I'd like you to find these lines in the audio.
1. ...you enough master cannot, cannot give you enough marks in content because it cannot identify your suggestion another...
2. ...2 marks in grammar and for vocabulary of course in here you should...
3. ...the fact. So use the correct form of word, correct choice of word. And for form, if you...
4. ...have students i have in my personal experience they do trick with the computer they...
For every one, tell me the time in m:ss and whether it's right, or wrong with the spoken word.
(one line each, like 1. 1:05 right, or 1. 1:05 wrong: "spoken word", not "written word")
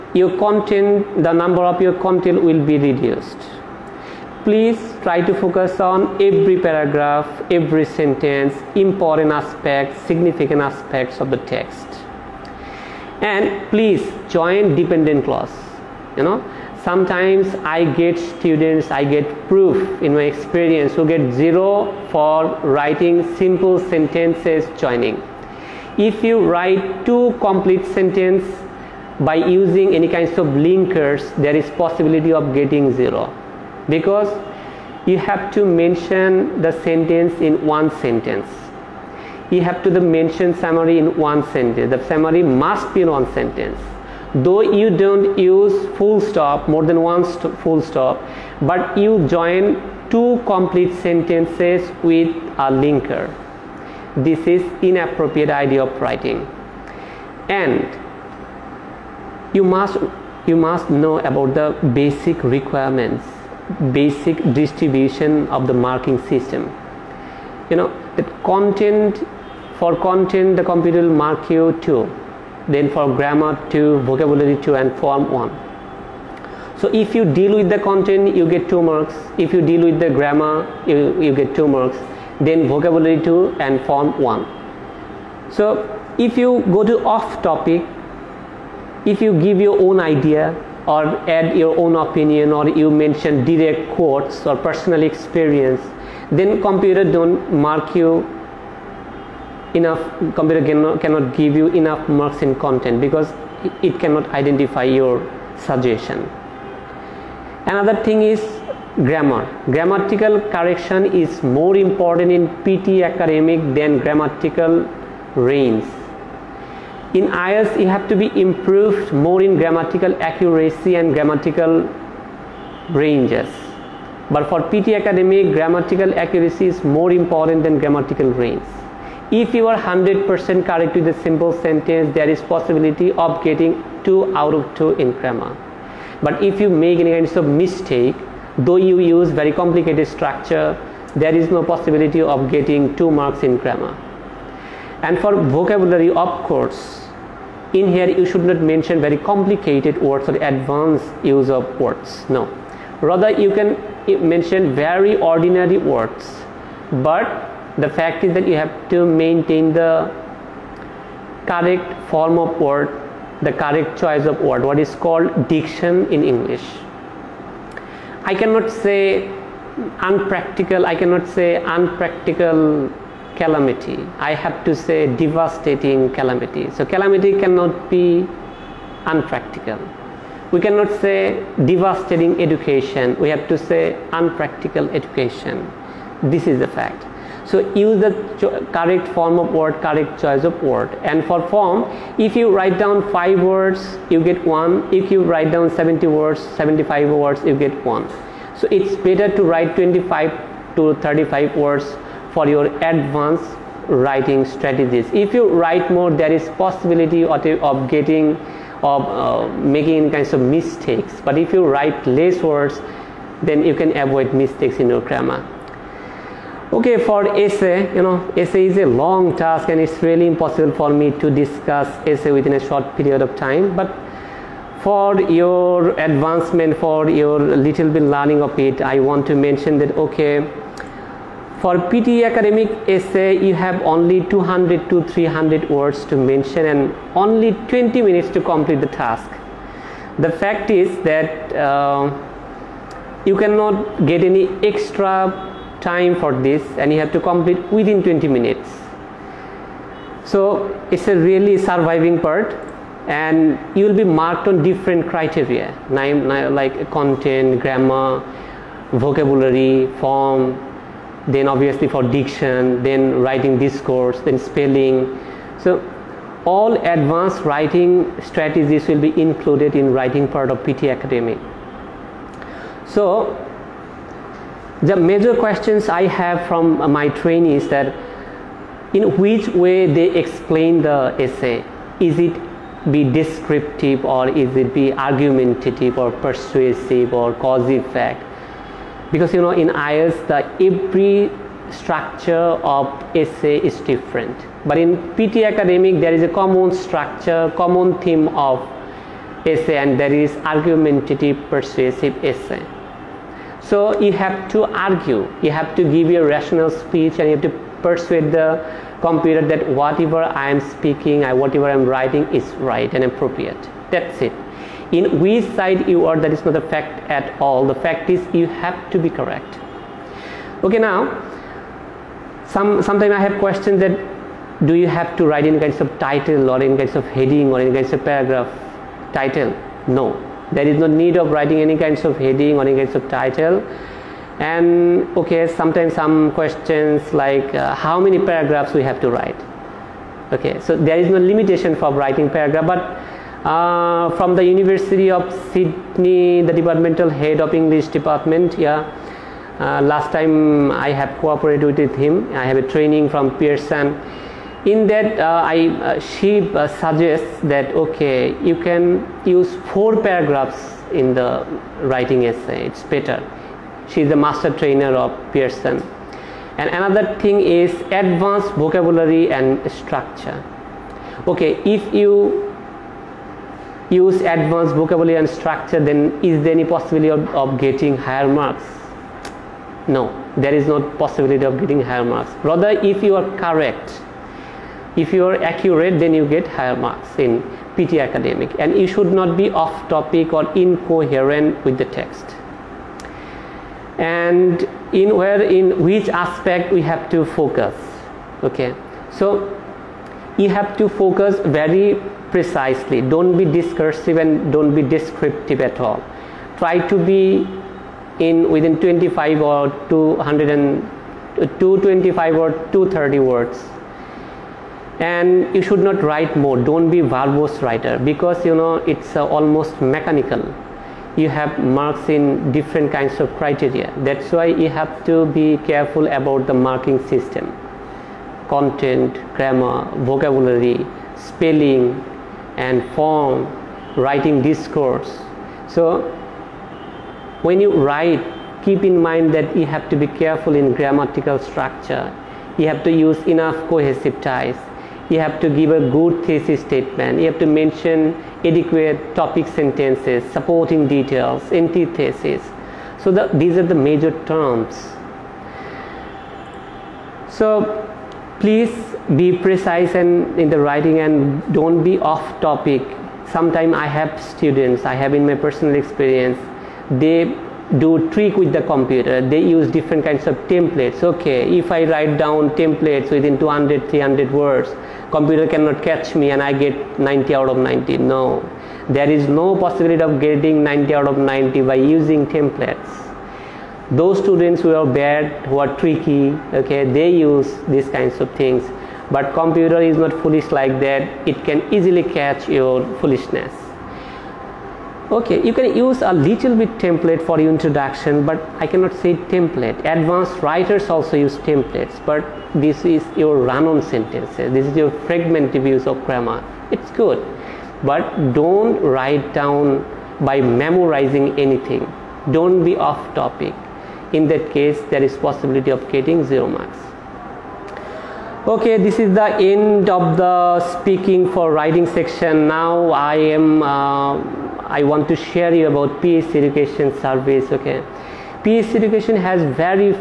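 1. 1:37 wrong: "computer", not "master"
2. 2:22 right
3. 3:06 right
4. 7:43 right.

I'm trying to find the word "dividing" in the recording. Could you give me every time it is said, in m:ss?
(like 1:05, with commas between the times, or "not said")
not said.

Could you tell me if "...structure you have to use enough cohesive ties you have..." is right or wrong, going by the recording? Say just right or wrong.
right.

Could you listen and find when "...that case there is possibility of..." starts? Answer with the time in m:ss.
8:34.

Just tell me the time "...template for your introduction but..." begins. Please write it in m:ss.
8:16.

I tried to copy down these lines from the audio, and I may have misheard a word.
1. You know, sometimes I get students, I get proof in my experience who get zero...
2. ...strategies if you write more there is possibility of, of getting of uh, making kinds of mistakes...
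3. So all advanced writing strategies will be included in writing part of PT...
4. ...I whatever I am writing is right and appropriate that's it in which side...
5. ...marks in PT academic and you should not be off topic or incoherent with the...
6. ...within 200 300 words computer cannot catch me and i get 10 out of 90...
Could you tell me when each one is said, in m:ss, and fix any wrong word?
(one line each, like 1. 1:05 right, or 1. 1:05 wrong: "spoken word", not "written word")
1. 0:16 right
2. 3:24 right
3. 4:25 right
4. 5:11 right
5. 6:26 right
6. 7:53 wrong: "90", not "10".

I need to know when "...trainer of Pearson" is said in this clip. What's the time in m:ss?
6:04.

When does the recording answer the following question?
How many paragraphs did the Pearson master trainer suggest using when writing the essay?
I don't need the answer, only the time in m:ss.
5:59.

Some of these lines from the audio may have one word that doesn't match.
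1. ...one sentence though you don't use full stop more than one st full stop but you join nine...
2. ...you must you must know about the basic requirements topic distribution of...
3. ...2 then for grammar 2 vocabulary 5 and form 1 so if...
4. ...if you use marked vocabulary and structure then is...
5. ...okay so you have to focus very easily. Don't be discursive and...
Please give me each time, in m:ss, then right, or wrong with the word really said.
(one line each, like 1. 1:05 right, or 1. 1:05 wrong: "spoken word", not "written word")
1. 0:43 wrong: "two", not "nine"
2. 0:59 wrong: "basic", not "topic"
3. 1:11 wrong: "2", not "5"
4. 6:11 wrong: "advanced", not "marked"
5. 6:38 wrong: "precisely", not "easily".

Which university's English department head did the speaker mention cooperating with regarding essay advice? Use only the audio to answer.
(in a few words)
University of Sydney.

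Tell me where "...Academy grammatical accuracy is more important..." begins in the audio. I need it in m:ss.
2:04.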